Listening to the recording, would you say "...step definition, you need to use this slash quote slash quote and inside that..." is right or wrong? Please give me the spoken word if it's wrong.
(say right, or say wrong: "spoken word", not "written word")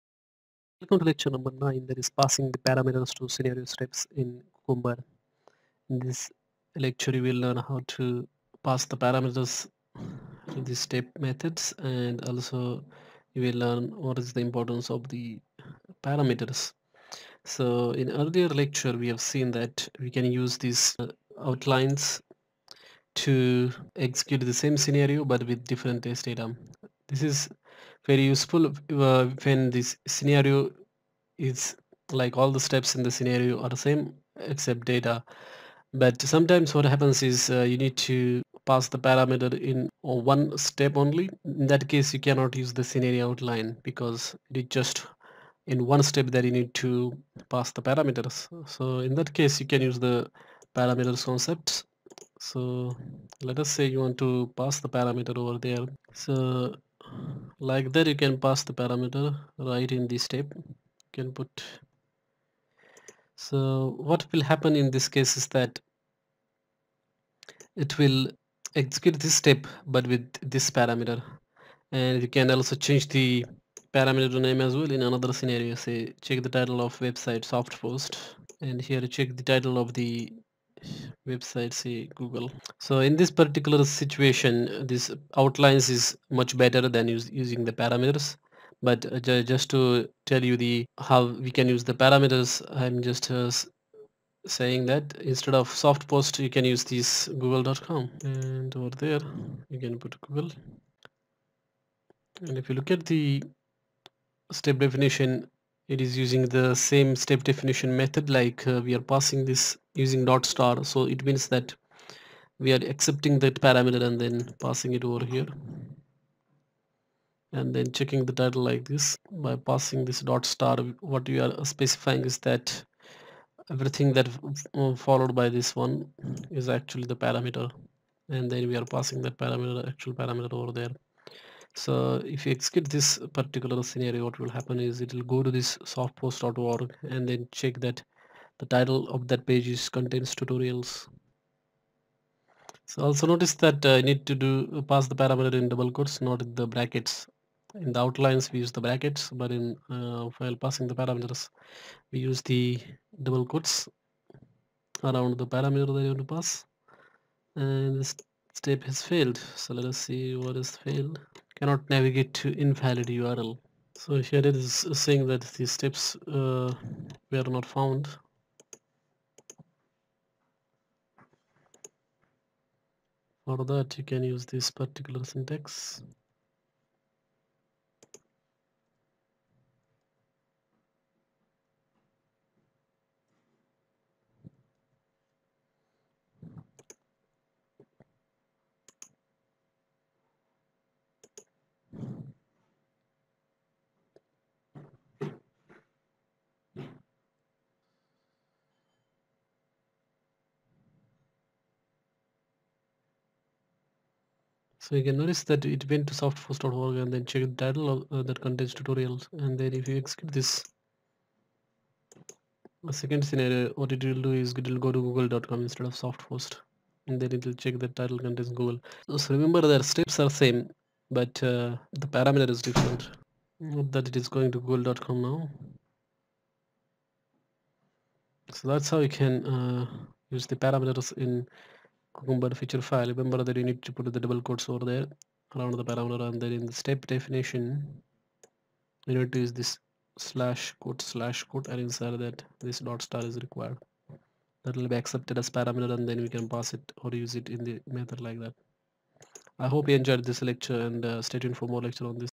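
right.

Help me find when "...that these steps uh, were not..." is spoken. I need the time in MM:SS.
02:45.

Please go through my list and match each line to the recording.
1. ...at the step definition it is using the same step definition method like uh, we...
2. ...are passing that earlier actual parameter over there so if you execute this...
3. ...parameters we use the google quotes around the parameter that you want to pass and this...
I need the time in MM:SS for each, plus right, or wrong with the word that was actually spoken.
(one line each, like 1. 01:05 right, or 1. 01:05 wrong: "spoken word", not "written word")
1. 01:42 right
2. 02:08 wrong: "parameter", not "earlier"
3. 02:30 wrong: "double", not "google".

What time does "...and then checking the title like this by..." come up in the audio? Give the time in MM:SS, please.
01:57.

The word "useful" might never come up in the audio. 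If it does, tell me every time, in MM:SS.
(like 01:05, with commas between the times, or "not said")
00:28.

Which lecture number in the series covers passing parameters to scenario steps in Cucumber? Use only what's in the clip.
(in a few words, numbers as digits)
9.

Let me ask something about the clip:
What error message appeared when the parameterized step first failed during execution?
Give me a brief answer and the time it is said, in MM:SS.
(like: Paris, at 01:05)
Cannot navigate to invalid URL, at 02:41.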